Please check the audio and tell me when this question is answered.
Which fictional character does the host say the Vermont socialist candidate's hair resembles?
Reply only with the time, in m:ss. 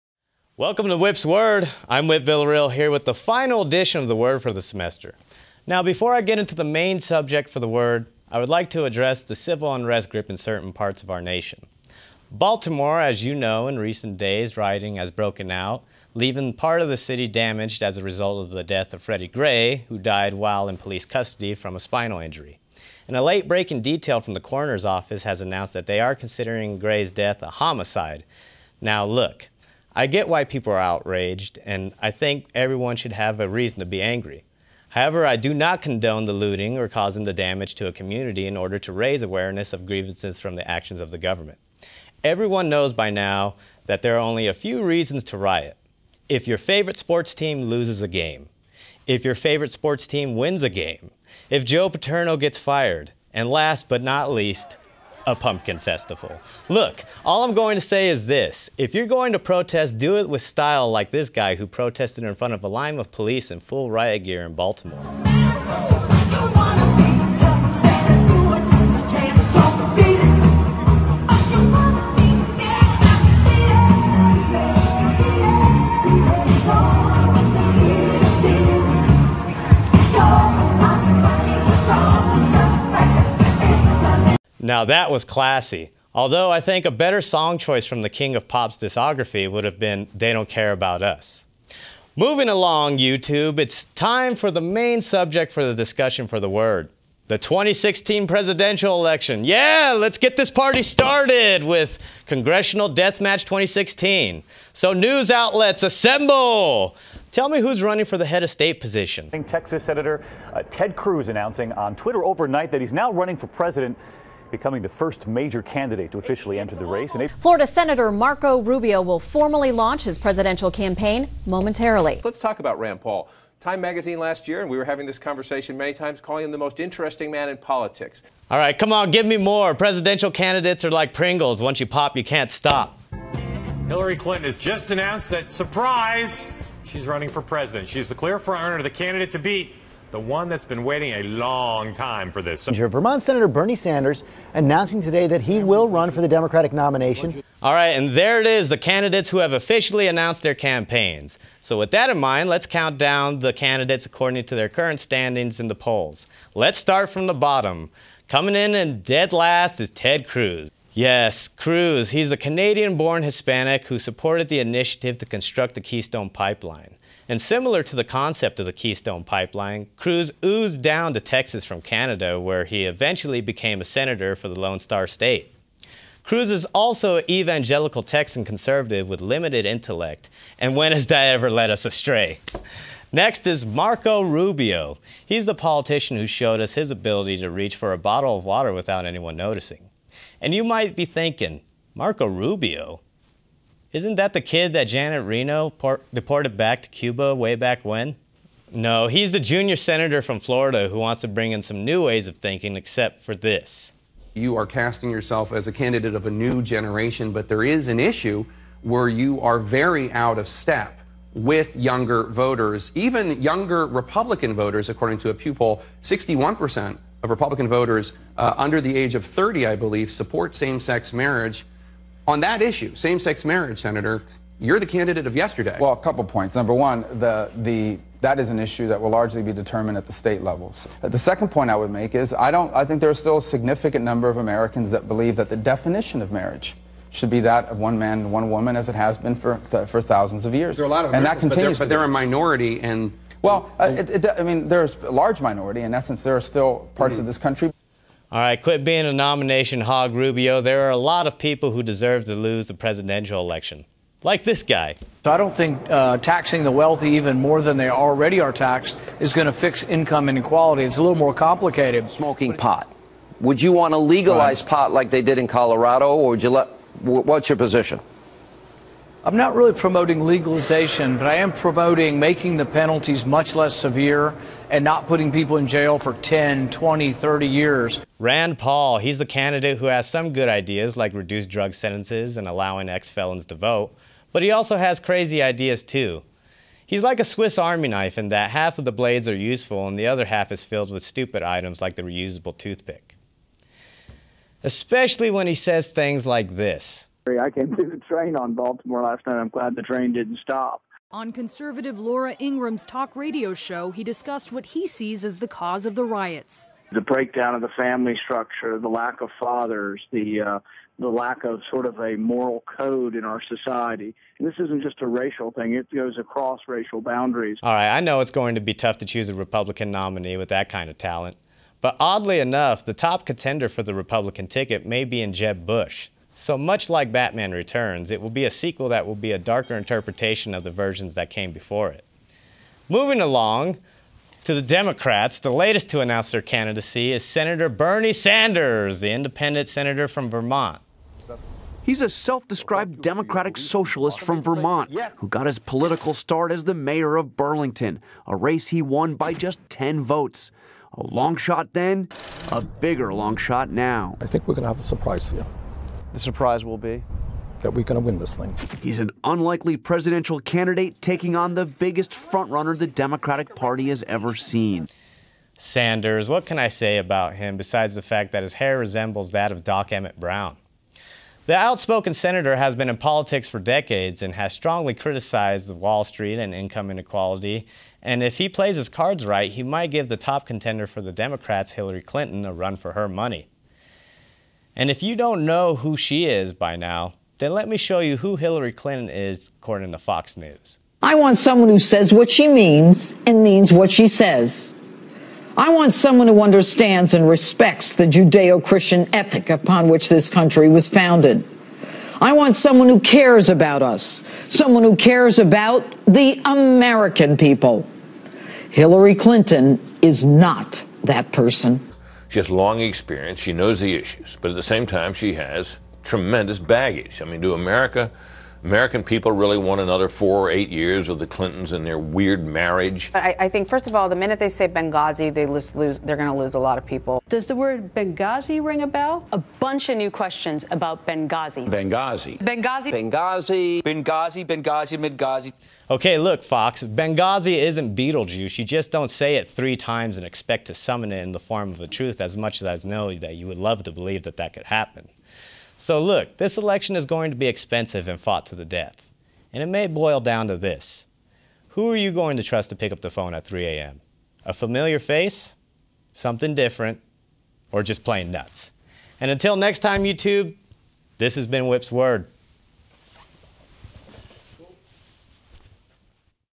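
6:09.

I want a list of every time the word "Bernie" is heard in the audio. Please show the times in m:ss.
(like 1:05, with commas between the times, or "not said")
2:23, 5:37.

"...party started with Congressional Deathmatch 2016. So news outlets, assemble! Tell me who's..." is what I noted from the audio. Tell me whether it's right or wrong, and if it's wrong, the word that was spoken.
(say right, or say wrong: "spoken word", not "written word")
right.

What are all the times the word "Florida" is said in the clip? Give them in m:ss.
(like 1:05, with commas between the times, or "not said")
1:57, 3:20.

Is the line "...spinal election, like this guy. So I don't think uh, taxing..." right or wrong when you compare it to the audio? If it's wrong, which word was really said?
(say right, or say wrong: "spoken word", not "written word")
wrong: "presidential", not "spinal".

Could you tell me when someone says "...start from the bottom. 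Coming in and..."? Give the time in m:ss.
2:36.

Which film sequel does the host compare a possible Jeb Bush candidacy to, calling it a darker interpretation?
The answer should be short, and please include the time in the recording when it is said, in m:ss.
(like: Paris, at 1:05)
Batman Returns, at 5:27.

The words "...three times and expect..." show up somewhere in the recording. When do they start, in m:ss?
7:19.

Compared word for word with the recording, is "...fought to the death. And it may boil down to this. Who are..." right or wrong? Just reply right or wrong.
right.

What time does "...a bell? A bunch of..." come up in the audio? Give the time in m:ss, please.
7:08.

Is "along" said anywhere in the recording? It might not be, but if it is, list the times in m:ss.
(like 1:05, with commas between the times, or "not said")
1:32, 5:33.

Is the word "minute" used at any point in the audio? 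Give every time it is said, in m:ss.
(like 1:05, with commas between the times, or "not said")
7:04.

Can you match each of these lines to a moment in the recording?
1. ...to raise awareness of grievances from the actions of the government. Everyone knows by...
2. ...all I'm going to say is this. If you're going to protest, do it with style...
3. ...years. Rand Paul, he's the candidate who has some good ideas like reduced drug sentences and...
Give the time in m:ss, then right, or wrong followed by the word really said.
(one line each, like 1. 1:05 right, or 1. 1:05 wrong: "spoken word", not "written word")
1. 0:38 right
2. 0:57 right
3. 4:37 right.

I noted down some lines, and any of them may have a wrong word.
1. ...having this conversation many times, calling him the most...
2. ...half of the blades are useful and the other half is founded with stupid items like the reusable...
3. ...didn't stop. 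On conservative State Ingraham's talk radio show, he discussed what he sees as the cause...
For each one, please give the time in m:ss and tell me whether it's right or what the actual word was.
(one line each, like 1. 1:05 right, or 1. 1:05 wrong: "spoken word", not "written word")
1. 2:04 right
2. 4:48 wrong: "filled", not "founded"
3. 5:00 wrong: "Laura", not "State".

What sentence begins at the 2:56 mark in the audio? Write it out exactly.
Cruz is also an evangelical Texan conservative with limited intellect, and when has that ever led us astray?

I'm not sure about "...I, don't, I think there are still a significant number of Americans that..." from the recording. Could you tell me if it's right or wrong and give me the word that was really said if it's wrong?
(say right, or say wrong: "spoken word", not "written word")
right.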